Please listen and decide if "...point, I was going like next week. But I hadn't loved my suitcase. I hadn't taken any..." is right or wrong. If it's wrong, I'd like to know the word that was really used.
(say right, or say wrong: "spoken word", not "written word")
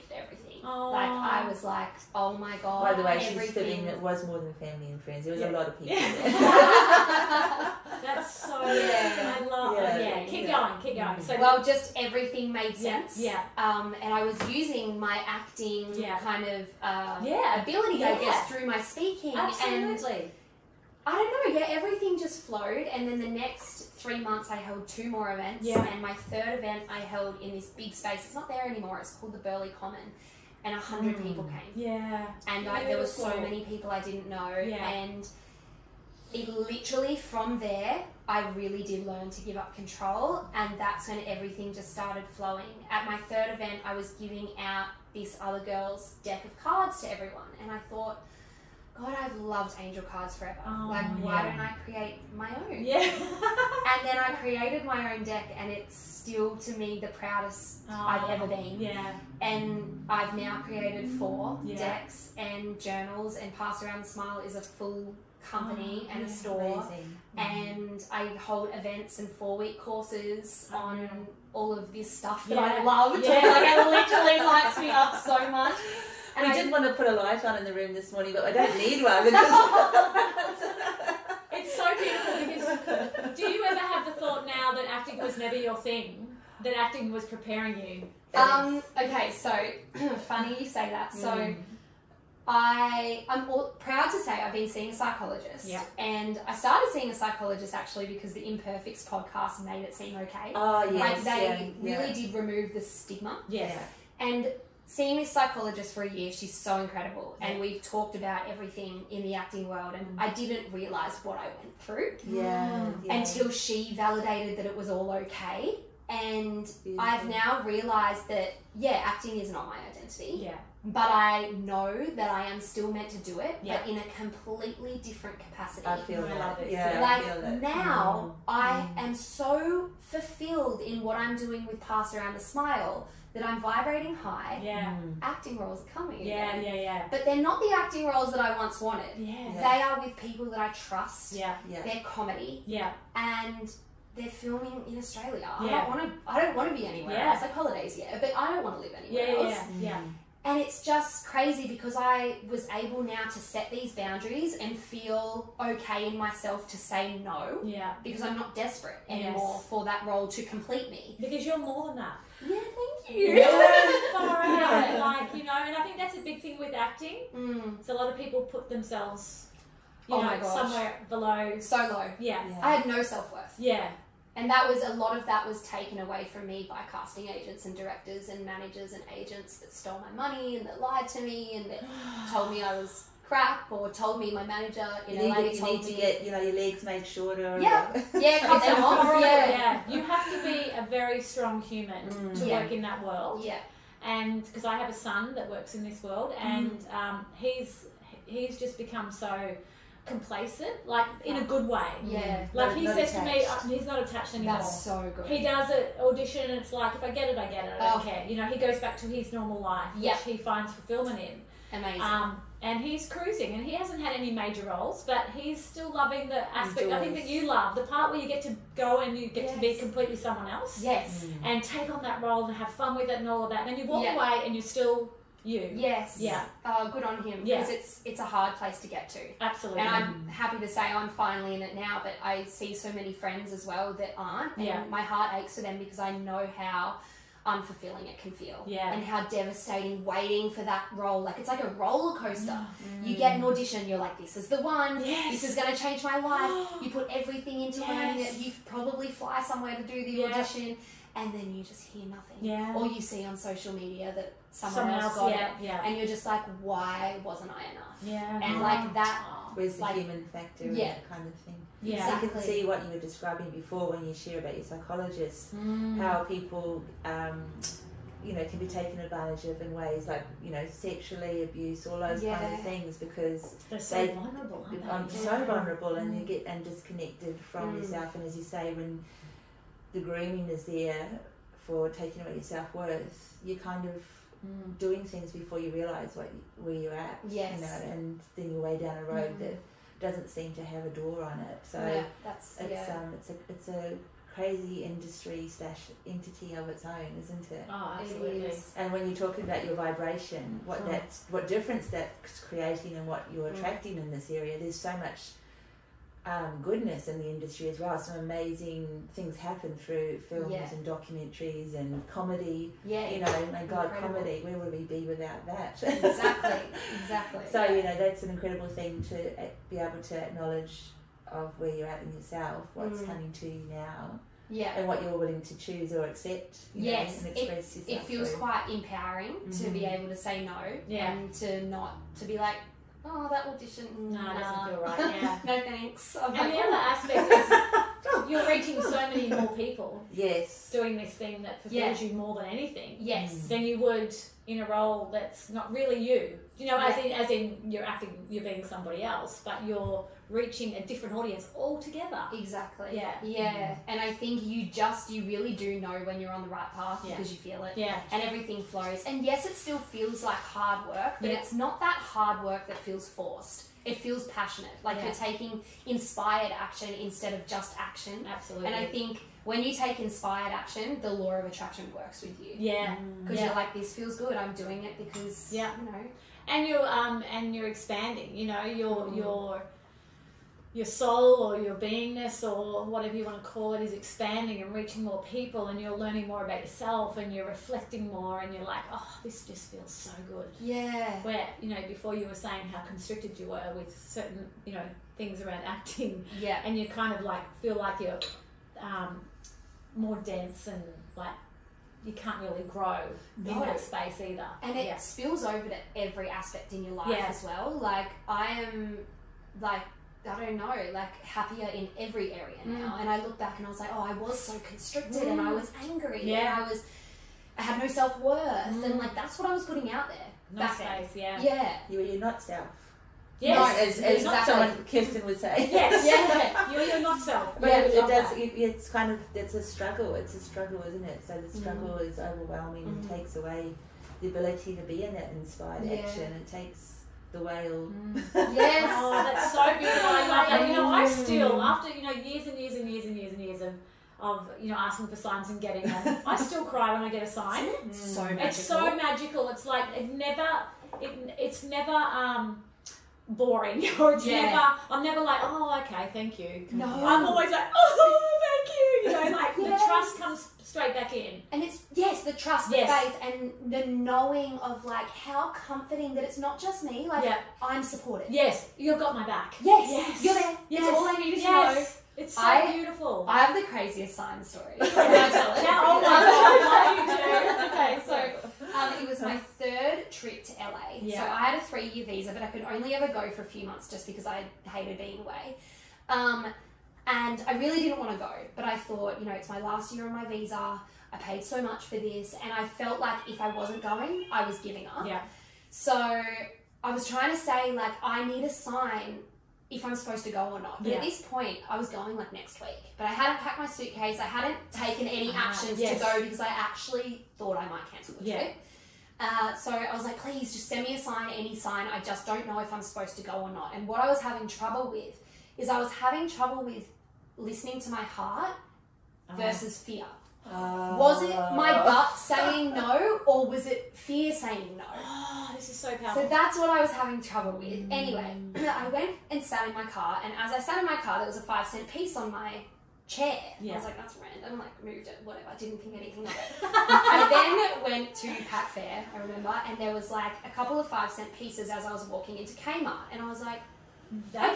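wrong: "packed", not "loved".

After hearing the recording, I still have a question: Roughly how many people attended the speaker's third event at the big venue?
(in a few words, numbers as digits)
100.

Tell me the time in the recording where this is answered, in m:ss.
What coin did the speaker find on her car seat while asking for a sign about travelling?
8:51.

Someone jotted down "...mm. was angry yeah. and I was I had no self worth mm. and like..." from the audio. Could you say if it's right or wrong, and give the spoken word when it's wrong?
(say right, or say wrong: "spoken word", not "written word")
right.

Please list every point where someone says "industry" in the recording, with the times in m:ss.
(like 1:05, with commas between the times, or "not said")
4:54, 5:07.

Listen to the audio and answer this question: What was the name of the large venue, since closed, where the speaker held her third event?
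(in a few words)
Burleigh Common.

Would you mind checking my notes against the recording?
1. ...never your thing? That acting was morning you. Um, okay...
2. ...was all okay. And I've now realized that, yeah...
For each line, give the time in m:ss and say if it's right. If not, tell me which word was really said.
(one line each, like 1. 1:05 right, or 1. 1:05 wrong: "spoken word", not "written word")
1. 1:25 wrong: "preparing", not "morning"
2. 1:54 right.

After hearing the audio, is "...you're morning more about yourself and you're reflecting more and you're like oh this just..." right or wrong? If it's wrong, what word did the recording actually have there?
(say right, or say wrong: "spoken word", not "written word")
wrong: "learning", not "morning".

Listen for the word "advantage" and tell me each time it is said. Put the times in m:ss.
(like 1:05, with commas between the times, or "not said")
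4:29.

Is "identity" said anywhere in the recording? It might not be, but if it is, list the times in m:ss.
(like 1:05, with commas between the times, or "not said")
1:59.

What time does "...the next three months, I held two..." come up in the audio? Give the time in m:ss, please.
0:23.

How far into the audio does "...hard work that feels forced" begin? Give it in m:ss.
6:01.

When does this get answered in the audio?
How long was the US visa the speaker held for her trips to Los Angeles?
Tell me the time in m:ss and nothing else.
8:01.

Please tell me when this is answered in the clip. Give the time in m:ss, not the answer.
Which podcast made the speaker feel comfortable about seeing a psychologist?
1:38.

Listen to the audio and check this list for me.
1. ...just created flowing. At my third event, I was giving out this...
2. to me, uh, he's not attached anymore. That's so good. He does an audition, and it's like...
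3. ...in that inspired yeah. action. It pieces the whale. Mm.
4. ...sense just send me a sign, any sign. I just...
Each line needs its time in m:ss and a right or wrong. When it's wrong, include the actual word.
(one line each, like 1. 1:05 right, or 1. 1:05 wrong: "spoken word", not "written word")
1. 0:41 wrong: "started", not "created"
2. 3:23 right
3. 7:15 wrong: "takes", not "pieces"
4. 8:30 wrong: "please", not "sense".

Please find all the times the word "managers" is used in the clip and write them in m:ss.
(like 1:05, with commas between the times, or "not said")
2:58, 3:04.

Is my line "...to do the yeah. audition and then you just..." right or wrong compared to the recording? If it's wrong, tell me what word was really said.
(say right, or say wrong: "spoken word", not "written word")
right.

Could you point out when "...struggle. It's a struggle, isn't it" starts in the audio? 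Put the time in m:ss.
7:09.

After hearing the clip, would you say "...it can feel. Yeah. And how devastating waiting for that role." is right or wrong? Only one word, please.
right.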